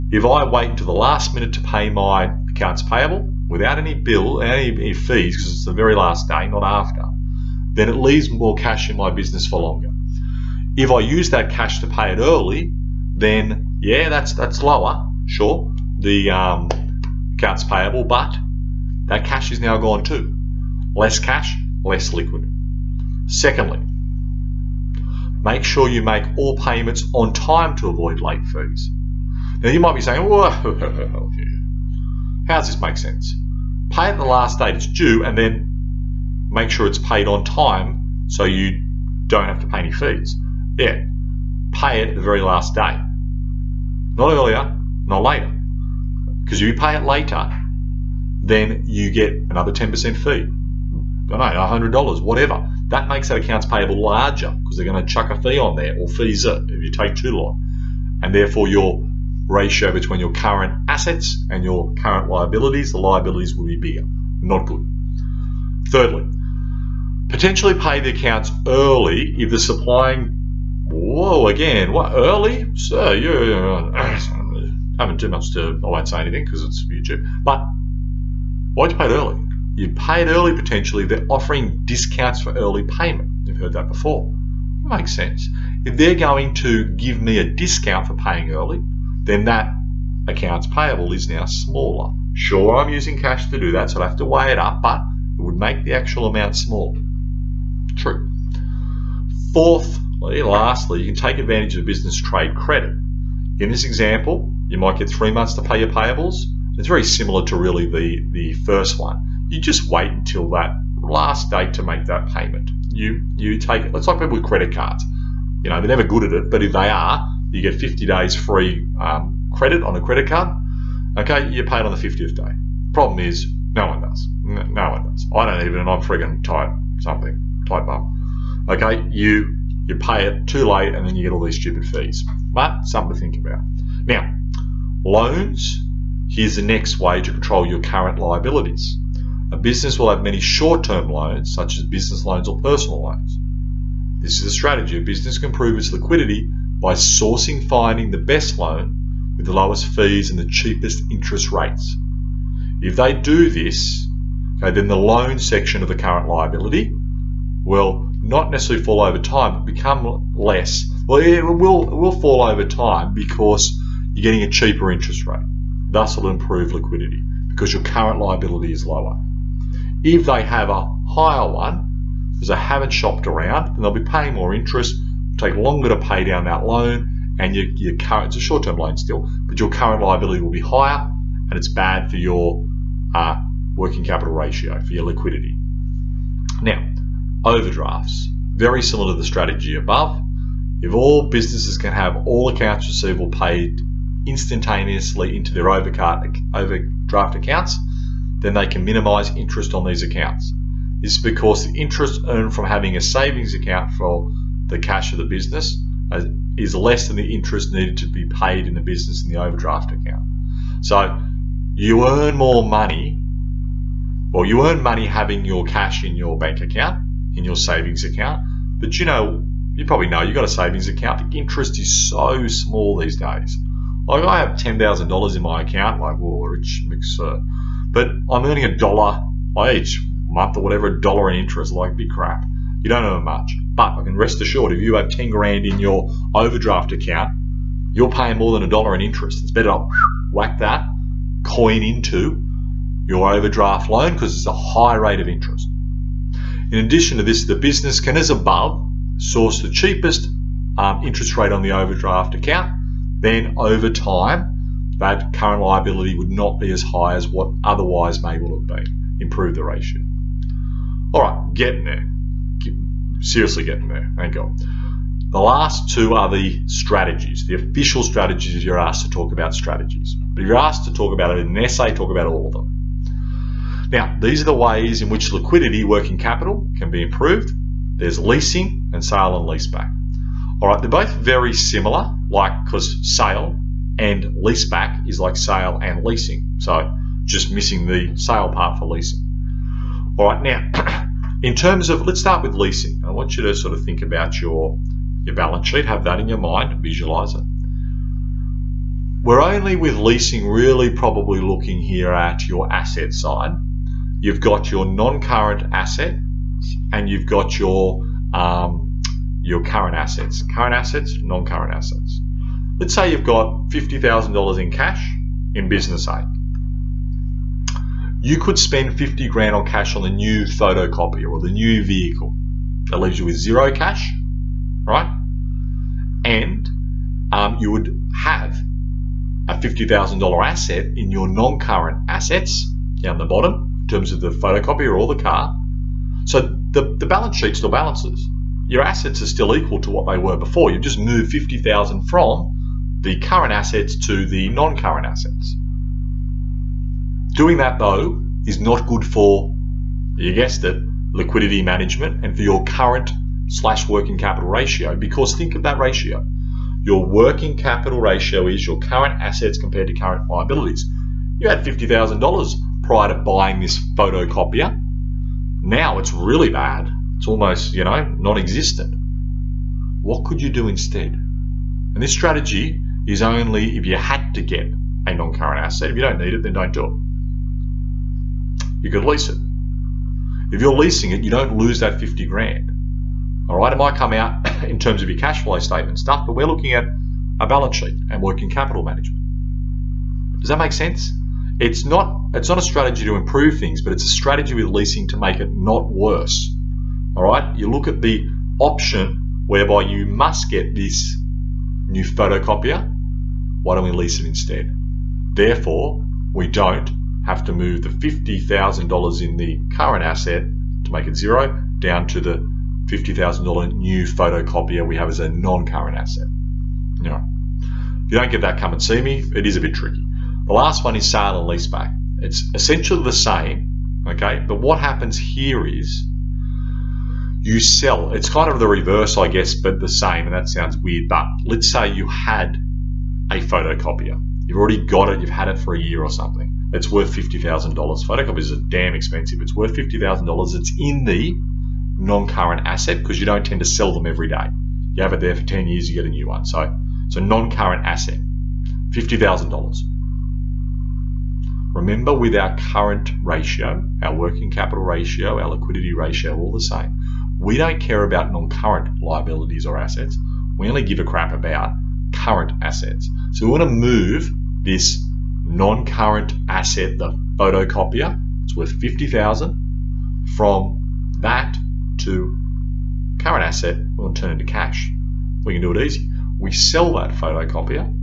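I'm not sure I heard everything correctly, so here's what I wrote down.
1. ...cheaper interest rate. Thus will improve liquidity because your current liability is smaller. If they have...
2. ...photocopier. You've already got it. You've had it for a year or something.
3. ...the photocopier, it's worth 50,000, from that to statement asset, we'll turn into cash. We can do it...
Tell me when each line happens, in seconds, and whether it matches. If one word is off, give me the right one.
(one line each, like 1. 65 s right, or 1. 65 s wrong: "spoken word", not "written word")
1. 164 s wrong: "lower", not "smaller"
2. 433 s right
3. 466 s wrong: "current", not "statement".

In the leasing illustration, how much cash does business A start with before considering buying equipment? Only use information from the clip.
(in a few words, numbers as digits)
$50,000.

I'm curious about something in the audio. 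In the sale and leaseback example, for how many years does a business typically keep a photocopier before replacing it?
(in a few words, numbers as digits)
10 years.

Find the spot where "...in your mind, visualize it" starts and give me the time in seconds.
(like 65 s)
296 s.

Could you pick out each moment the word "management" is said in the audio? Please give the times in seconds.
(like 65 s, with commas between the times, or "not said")
351 s, 388 s.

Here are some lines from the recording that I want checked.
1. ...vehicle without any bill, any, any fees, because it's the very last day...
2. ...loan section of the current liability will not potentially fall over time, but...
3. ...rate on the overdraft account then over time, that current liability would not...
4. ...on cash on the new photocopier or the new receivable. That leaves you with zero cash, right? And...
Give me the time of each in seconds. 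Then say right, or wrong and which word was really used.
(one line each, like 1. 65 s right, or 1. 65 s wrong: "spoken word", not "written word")
1. 2 s wrong: "payable", not "vehicle"
2. 154 s wrong: "necessarily", not "potentially"
3. 251 s right
4. 319 s wrong: "vehicle", not "receivable".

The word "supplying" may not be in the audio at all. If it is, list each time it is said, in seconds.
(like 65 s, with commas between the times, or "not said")
69 s.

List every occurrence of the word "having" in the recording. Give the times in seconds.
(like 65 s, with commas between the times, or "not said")
202 s, 215 s.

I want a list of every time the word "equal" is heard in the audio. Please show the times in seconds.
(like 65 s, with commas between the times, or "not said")
339 s.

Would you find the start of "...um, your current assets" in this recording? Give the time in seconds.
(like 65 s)
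308 s.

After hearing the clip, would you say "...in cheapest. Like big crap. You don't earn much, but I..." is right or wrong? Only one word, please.
wrong.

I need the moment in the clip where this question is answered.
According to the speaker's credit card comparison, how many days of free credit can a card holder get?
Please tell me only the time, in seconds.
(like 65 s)
117 s.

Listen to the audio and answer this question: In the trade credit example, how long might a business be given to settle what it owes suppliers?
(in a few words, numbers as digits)
three months.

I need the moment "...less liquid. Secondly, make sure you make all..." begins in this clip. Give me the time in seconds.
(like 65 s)
21 s.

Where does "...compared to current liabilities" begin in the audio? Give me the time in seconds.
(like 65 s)
359 s.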